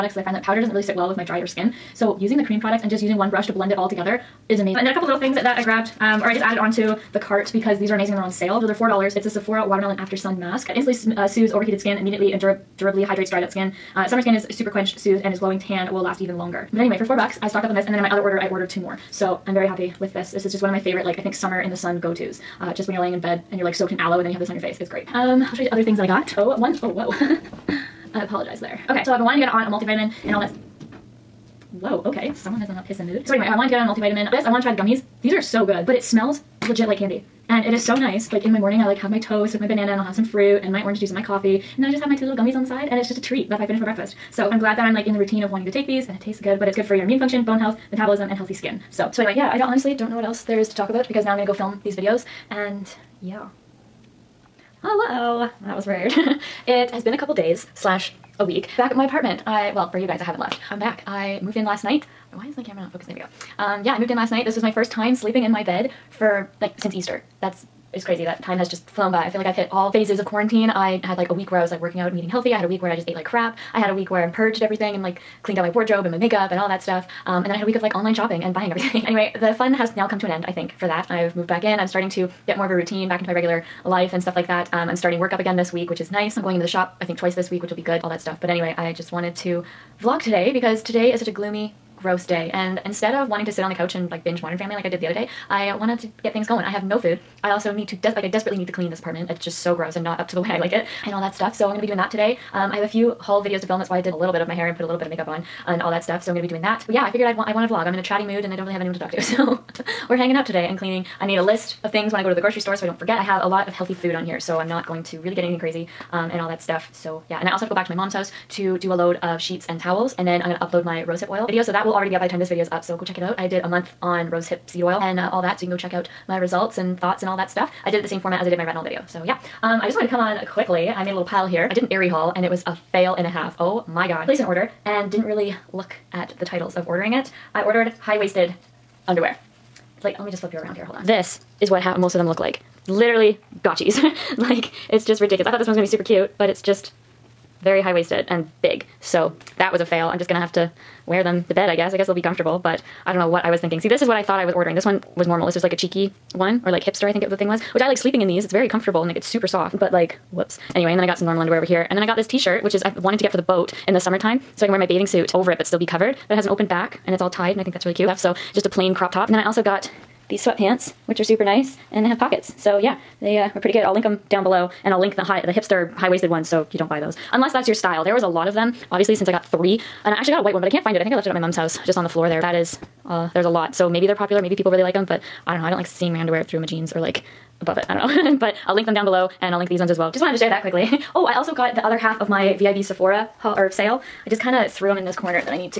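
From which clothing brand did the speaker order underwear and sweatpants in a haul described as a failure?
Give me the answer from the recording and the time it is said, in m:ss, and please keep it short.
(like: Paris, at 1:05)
Aerie, at 2:11.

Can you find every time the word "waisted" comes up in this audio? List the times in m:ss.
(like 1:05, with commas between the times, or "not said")
2:18, 2:27, 2:55.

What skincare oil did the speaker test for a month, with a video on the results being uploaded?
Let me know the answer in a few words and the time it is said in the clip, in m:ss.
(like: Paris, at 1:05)
rosehip seed oil, at 2:04.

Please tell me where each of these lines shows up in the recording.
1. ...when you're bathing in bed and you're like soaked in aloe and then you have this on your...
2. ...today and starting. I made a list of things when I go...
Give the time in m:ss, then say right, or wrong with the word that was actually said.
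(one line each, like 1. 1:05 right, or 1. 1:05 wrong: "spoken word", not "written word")
1. 0:22 wrong: "laying", not "bathing"
2. 1:50 wrong: "cleaning", not "starting".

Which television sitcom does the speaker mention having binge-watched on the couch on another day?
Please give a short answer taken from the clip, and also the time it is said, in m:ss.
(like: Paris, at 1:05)
Modern Family, at 1:34.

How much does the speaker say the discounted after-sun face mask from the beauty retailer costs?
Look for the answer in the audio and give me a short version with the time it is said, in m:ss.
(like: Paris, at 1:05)
$4, at 0:08.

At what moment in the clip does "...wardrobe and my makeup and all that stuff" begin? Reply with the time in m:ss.
1:15.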